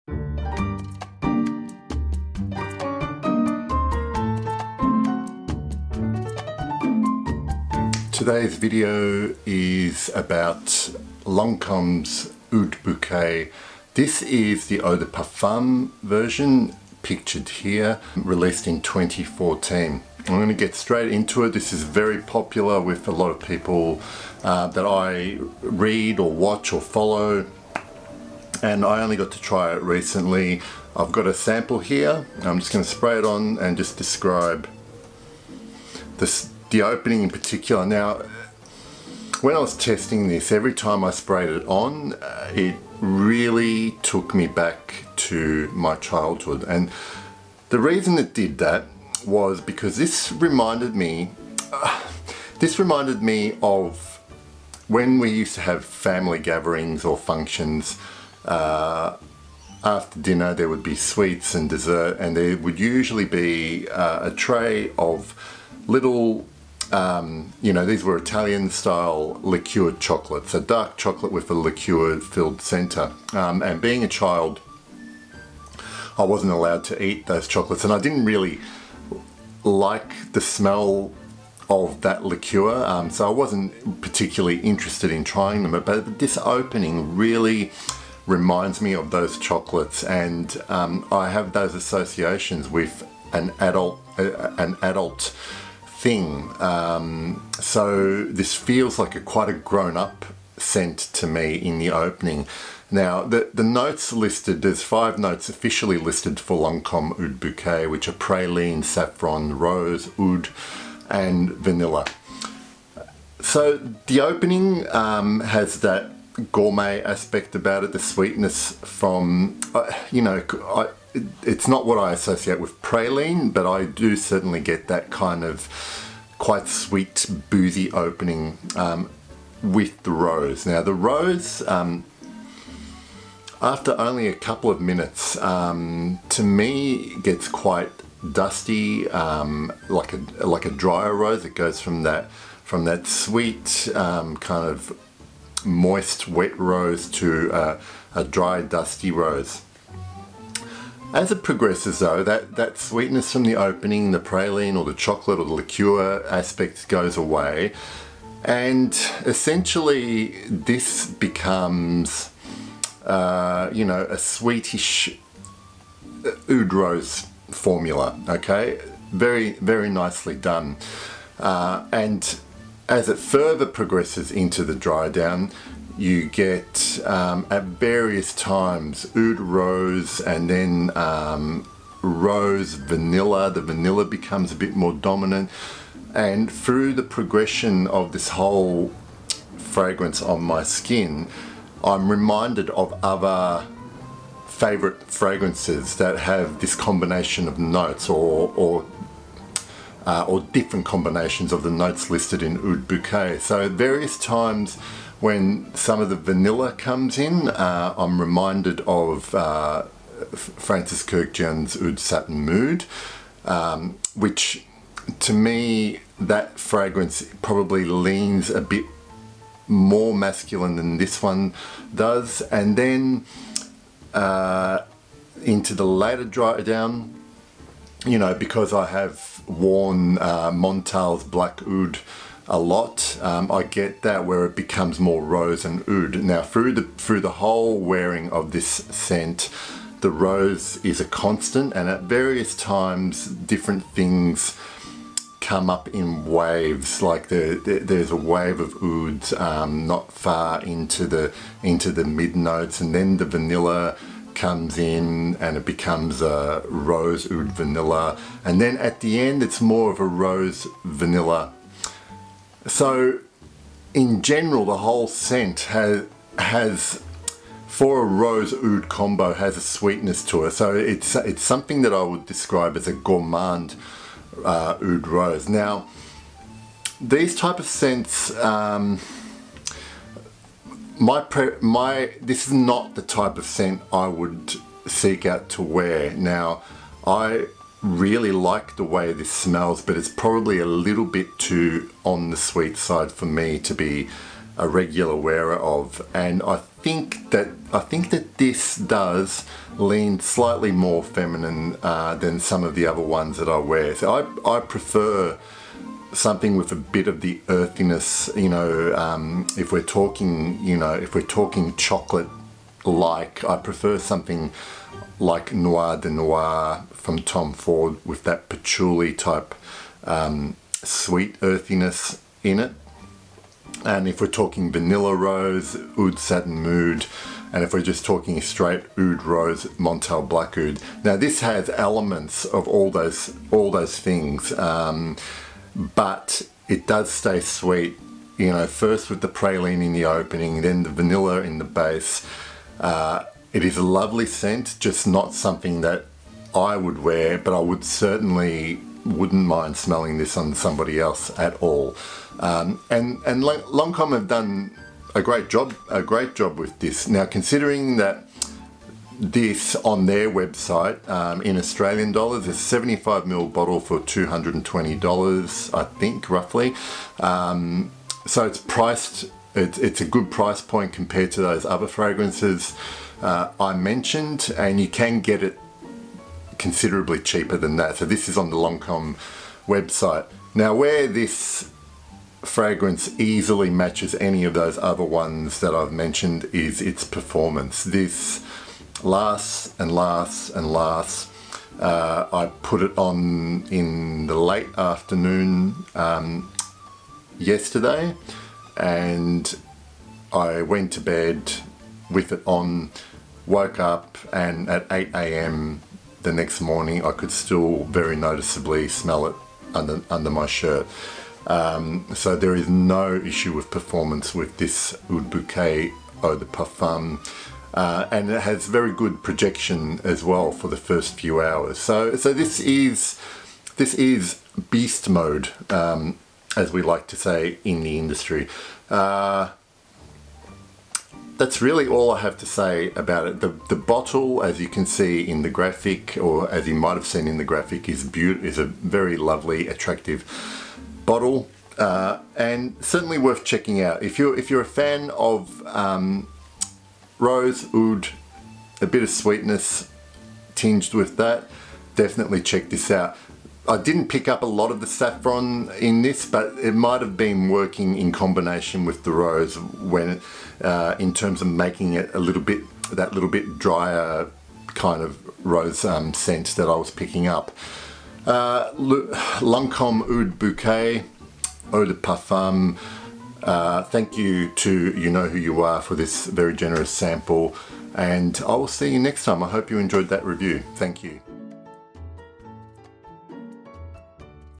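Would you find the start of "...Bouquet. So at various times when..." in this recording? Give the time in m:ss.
3:22.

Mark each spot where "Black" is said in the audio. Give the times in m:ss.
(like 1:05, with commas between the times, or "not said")
3:51, 5:30.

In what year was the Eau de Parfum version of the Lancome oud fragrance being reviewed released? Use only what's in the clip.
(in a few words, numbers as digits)
2014.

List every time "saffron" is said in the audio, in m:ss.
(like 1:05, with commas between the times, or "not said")
1:48, 7:34.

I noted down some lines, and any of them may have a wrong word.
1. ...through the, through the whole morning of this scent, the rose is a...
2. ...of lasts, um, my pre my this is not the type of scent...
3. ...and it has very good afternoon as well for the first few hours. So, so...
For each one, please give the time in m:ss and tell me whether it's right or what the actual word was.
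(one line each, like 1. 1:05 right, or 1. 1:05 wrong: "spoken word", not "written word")
1. 3:56 wrong: "wearing", not "morning"
2. 4:37 wrong: "scents", not "lasts"
3. 6:58 wrong: "projection", not "afternoon".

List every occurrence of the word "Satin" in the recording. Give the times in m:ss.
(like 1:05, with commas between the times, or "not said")
3:31, 5:26.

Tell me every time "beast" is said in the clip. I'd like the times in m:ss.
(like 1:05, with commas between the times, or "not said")
7:04.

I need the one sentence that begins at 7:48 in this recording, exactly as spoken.
Uh, Lancome Oud Bouquet, Eau de Parfum.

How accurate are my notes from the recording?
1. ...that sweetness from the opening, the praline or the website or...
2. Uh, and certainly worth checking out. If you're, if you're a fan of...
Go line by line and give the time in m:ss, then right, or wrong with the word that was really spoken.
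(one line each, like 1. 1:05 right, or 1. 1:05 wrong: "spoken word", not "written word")
1. 2:32 wrong: "chocolate", not "website"
2. 7:21 right.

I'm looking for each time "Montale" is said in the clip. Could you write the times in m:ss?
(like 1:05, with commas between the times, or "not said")
3:50, 5:29.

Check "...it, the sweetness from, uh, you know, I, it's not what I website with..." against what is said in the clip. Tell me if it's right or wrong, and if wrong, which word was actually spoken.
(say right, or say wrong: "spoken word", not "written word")
wrong: "associate", not "website".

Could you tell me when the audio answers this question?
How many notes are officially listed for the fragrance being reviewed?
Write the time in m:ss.
1:44.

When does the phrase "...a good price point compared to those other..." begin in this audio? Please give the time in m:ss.
6:09.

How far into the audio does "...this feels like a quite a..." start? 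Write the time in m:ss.
1:38.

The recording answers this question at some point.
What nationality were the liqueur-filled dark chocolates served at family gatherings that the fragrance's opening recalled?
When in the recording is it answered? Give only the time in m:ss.
1:08.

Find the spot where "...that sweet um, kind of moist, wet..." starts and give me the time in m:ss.
2:22.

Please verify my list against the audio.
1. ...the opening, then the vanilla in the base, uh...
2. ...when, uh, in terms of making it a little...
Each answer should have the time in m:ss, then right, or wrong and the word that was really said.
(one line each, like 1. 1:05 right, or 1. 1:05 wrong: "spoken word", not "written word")
1. 5:39 right
2. 7:39 right.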